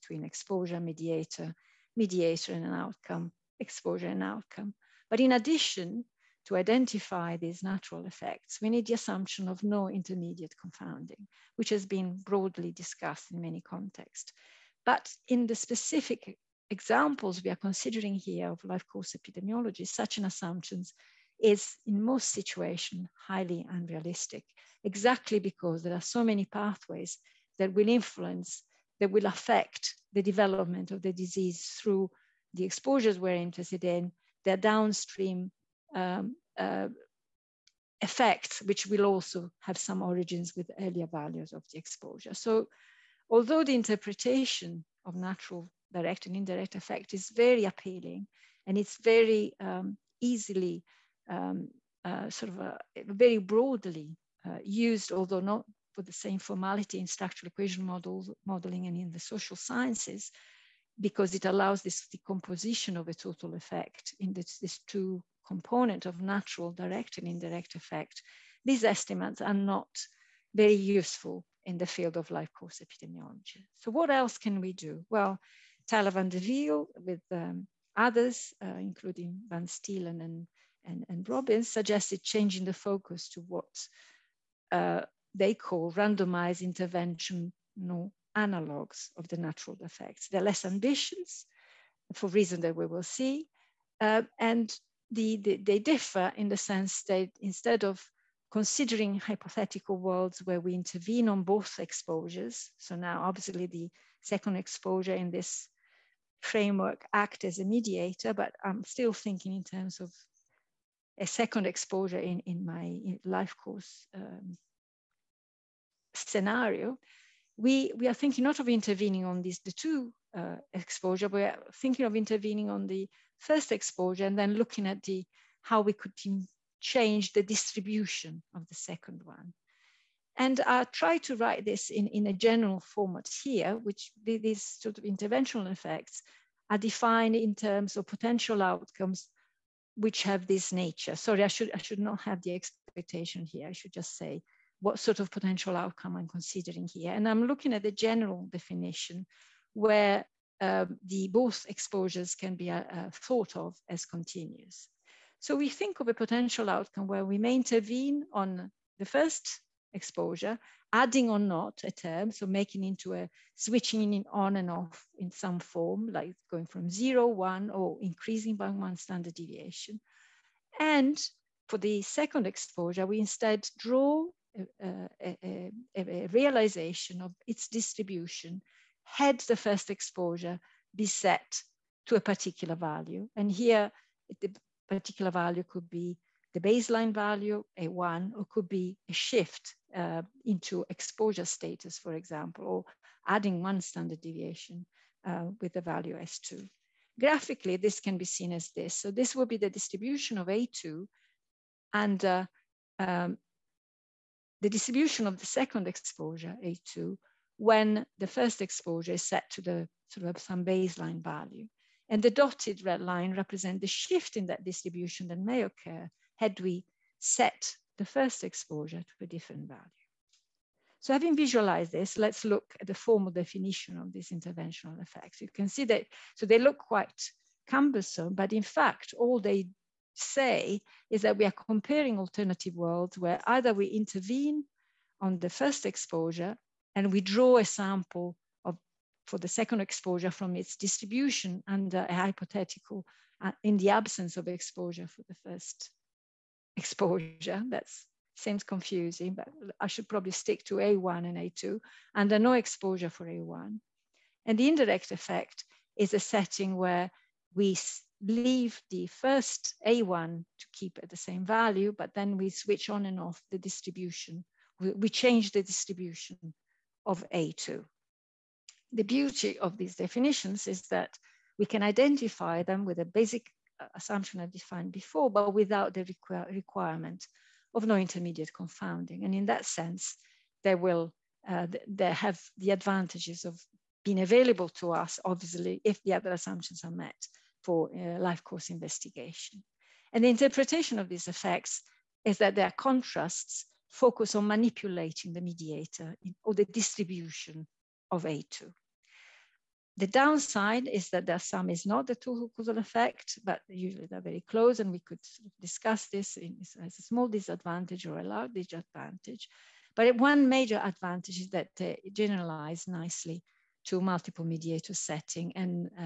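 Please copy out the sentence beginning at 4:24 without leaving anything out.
we change the distribution of A2.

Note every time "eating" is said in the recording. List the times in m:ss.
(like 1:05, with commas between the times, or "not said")
not said.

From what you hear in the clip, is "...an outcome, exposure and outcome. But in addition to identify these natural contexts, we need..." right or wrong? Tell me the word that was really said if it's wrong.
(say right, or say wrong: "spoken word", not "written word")
wrong: "effects", not "contexts".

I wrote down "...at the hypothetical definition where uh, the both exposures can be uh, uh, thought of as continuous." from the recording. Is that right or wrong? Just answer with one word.
wrong.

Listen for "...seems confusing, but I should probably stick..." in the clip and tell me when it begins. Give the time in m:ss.
4:08.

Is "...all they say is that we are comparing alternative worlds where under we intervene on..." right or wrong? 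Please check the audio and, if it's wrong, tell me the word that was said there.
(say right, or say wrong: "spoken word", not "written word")
wrong: "either", not "under".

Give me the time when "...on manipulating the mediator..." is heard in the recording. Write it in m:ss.
4:54.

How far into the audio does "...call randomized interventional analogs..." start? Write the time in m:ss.
1:25.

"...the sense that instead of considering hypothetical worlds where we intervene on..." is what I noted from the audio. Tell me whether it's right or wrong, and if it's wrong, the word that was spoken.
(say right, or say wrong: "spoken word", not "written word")
right.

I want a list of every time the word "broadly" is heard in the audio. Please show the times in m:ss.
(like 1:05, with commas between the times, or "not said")
0:12, 0:53.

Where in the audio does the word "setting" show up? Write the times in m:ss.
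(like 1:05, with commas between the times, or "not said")
4:16, 5:14.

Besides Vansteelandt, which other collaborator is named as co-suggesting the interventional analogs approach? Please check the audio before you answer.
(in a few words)
Robins.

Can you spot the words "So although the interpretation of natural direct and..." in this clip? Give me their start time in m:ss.
0:42.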